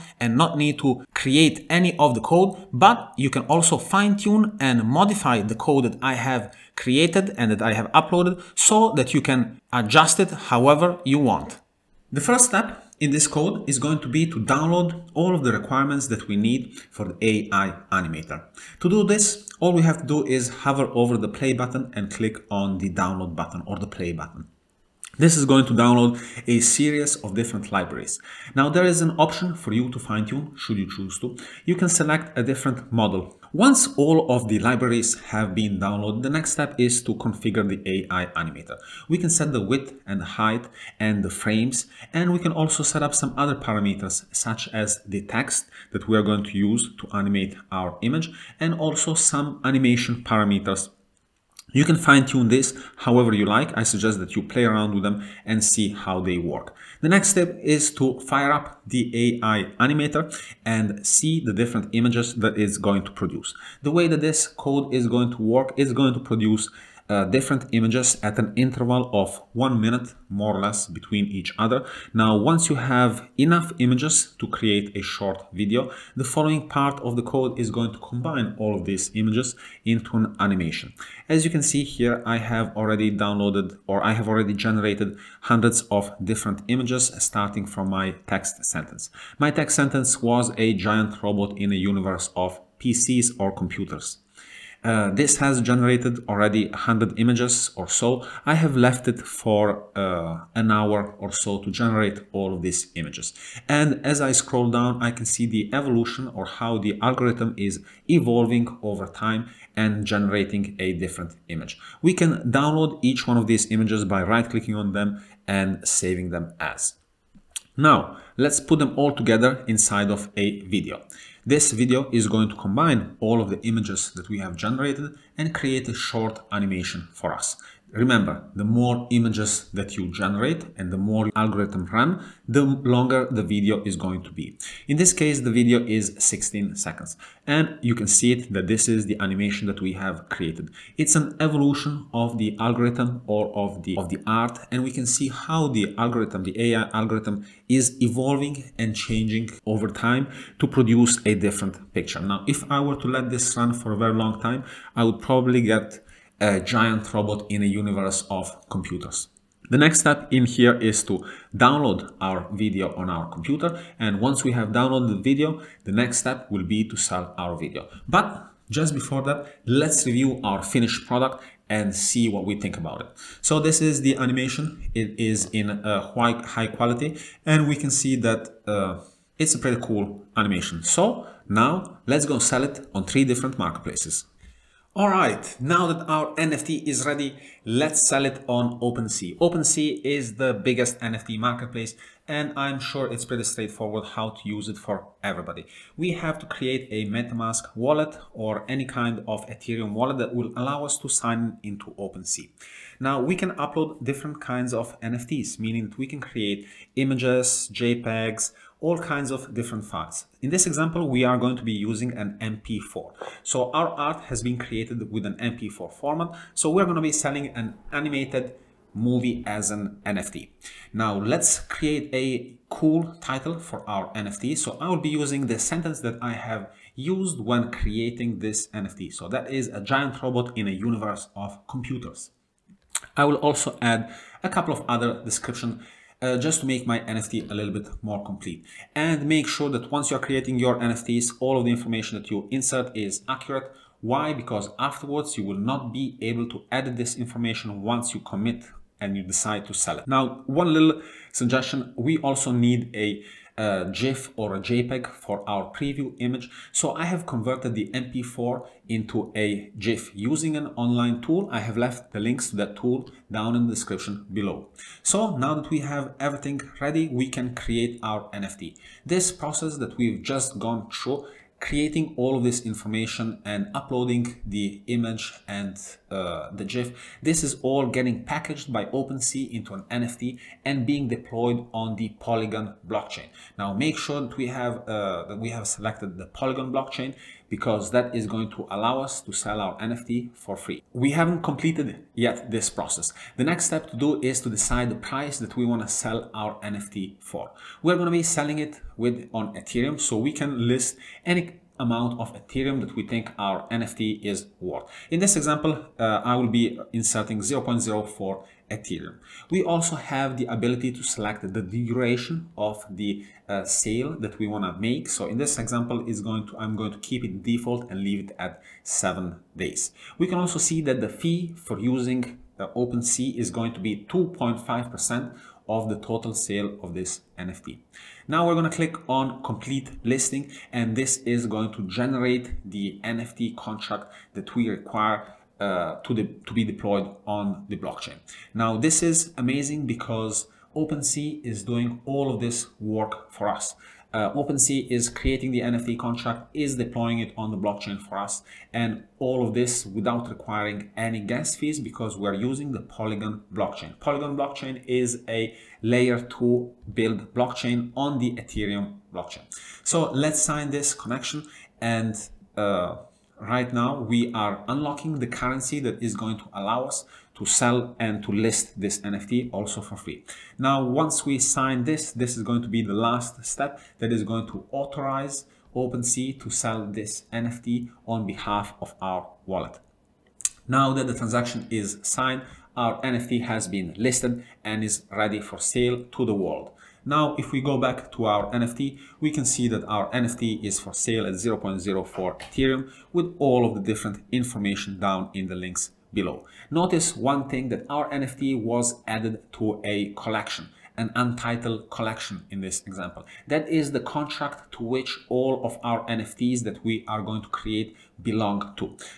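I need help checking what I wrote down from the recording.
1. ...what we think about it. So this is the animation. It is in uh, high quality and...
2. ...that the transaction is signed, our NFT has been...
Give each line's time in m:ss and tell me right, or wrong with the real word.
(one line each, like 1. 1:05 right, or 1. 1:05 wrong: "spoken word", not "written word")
1. 2:52 right
2. 6:20 right.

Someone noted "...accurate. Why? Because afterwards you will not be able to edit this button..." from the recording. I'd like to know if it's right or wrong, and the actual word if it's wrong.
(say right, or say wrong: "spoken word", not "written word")
wrong: "information", not "button".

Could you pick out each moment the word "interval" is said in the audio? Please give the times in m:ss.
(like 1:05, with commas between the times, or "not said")
1:08.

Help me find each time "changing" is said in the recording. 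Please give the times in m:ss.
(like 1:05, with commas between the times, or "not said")
2:28.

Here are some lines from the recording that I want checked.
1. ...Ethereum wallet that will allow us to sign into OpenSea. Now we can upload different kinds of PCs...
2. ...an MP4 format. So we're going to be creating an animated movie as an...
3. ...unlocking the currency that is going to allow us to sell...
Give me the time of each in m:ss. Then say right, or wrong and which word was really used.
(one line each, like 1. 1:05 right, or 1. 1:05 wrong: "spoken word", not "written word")
1. 3:19 wrong: "NFTs", not "PCs"
2. 3:35 wrong: "selling", not "creating"
3. 6:04 right.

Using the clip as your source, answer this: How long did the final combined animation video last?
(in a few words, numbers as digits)
16 seconds.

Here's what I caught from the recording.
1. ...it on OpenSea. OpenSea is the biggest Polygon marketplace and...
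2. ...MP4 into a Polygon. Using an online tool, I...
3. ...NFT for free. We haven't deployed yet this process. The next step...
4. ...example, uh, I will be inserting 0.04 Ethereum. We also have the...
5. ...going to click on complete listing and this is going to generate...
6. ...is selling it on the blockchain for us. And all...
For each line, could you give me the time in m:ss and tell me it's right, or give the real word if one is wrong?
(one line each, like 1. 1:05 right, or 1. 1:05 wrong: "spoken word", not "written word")
1. 3:08 wrong: "NFT", not "Polygon"
2. 4:17 wrong: "GIF", not "Polygon"
3. 4:49 wrong: "completed", not "deployed"
4. 5:05 right
5. 5:28 right
6. 5:46 wrong: "deploying", not "selling".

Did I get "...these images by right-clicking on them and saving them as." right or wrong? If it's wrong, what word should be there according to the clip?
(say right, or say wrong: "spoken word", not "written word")
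right.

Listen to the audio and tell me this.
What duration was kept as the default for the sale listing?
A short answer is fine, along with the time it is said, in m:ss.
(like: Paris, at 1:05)
Seven days, at 5:18.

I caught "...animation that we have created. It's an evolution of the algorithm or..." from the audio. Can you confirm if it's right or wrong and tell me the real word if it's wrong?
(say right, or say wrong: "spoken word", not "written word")
right.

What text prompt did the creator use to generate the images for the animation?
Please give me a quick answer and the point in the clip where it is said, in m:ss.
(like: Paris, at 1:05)
A giant robot in a universe of PCs, at 1:30.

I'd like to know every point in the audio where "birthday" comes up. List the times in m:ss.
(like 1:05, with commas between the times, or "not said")
not said.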